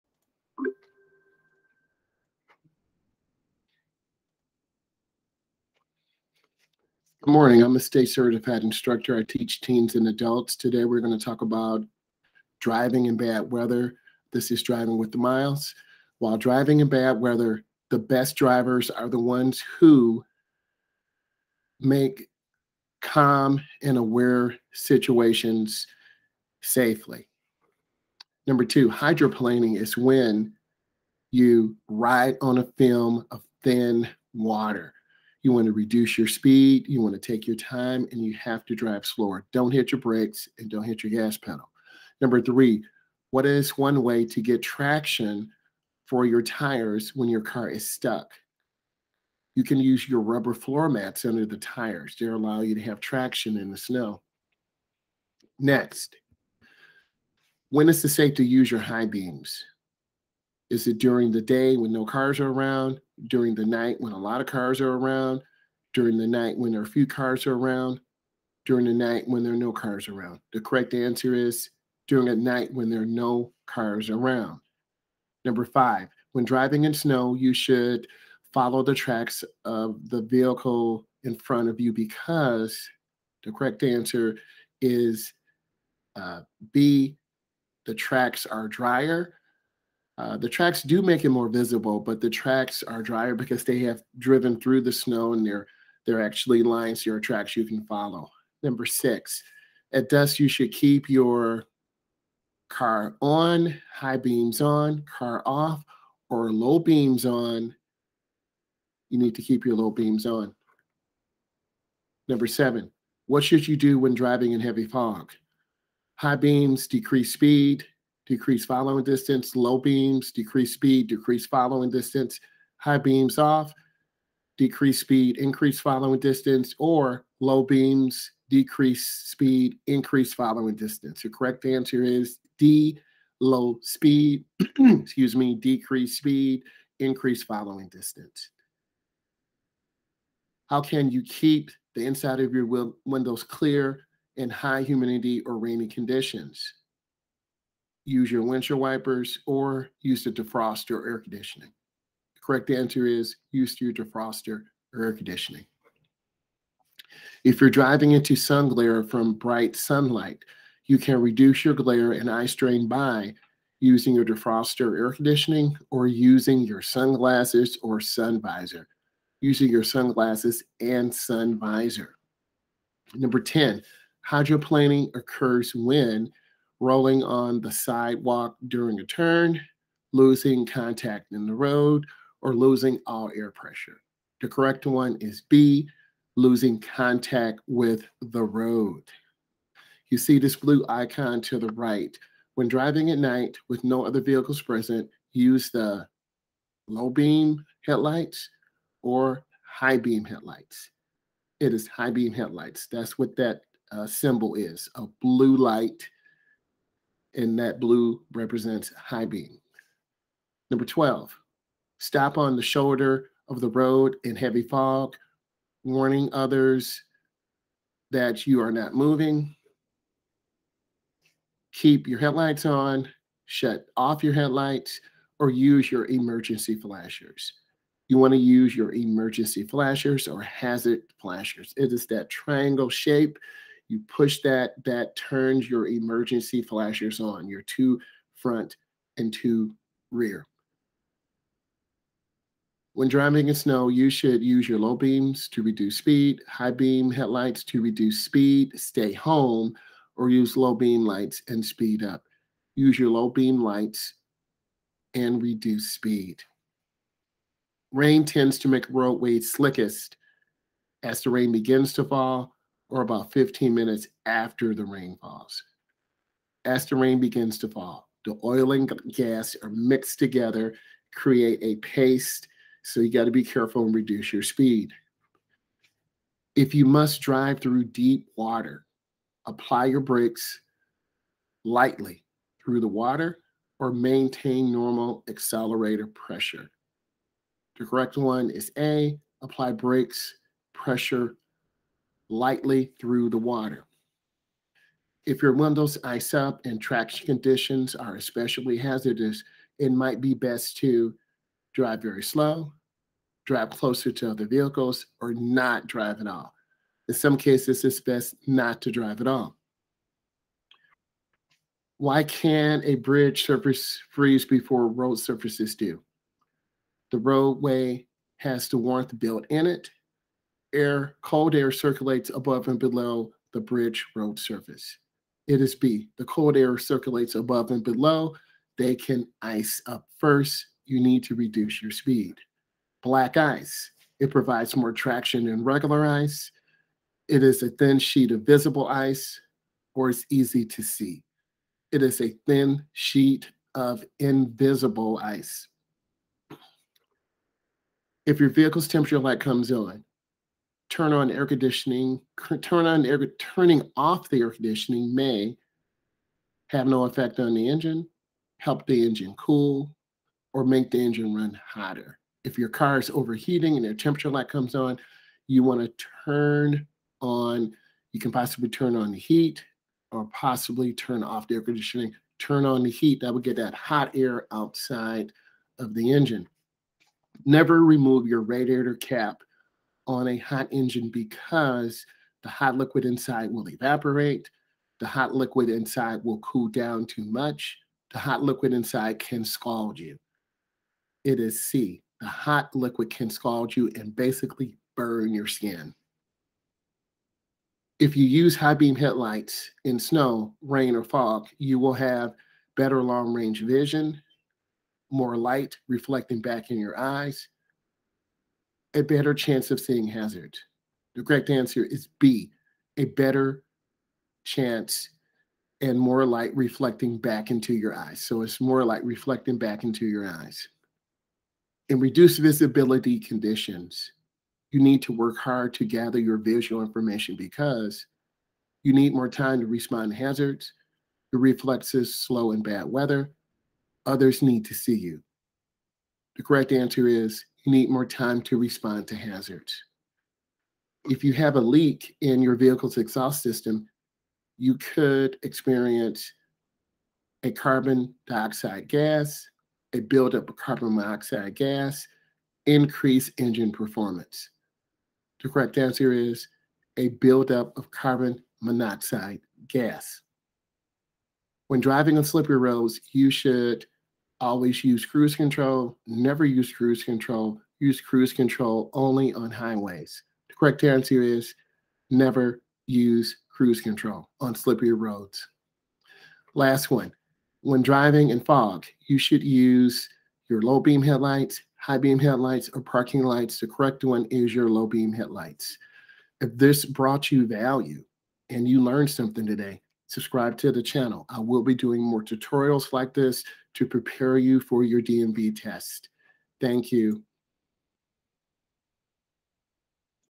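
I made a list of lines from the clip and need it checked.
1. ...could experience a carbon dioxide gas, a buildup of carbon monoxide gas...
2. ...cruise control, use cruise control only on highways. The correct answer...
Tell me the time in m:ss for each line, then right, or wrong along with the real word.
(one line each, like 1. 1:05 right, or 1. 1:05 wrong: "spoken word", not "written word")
1. 7:24 right
2. 7:46 right.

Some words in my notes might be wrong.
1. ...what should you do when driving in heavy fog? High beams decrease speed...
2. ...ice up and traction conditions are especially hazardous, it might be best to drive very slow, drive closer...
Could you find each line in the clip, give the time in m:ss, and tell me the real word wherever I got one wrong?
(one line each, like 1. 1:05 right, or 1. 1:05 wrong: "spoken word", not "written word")
1. 1:53 right
2. 4:56 right.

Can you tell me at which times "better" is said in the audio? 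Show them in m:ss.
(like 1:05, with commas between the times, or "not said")
6:42, 6:49, 6:53.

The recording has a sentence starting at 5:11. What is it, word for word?
Why can a bridge surface freeze before road surfaces do?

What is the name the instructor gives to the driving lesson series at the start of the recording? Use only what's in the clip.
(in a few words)
Driving with the Myles.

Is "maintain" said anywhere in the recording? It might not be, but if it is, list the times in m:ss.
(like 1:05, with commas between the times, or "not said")
4:43.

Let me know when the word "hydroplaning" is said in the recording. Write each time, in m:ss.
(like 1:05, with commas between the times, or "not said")
0:28, 2:54.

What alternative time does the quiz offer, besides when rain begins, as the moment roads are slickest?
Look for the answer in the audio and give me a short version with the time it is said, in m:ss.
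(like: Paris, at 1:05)
About 15 minutes after, at 4:23.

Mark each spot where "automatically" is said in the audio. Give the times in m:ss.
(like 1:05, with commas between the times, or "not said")
not said.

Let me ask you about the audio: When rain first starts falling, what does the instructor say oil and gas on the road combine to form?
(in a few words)
A paste.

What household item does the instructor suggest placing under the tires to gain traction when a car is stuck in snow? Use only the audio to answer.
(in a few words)
Rubber floor mats.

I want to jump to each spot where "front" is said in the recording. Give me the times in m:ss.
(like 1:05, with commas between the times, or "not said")
1:21, 3:58.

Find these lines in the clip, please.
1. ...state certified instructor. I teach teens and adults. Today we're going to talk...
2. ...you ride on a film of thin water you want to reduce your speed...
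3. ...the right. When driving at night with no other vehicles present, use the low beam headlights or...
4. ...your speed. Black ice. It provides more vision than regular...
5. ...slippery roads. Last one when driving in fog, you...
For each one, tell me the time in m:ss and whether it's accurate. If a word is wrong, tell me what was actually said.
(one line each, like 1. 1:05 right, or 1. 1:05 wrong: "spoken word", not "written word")
1. 0:07 right
2. 0:31 right
3. 3:11 right
4. 5:31 wrong: "traction", not "vision"
5. 7:54 right.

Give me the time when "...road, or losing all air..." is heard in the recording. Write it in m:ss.
3:01.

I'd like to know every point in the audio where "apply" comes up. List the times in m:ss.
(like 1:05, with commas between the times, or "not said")
4:39, 4:49.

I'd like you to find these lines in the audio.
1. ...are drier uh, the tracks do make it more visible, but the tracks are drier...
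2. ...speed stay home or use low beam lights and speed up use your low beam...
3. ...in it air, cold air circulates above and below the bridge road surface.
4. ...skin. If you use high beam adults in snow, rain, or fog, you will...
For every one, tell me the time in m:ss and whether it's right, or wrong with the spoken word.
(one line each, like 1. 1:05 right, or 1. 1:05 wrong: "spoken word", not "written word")
1. 1:28 right
2. 4:08 right
3. 5:19 right
4. 6:35 wrong: "headlights", not "adults".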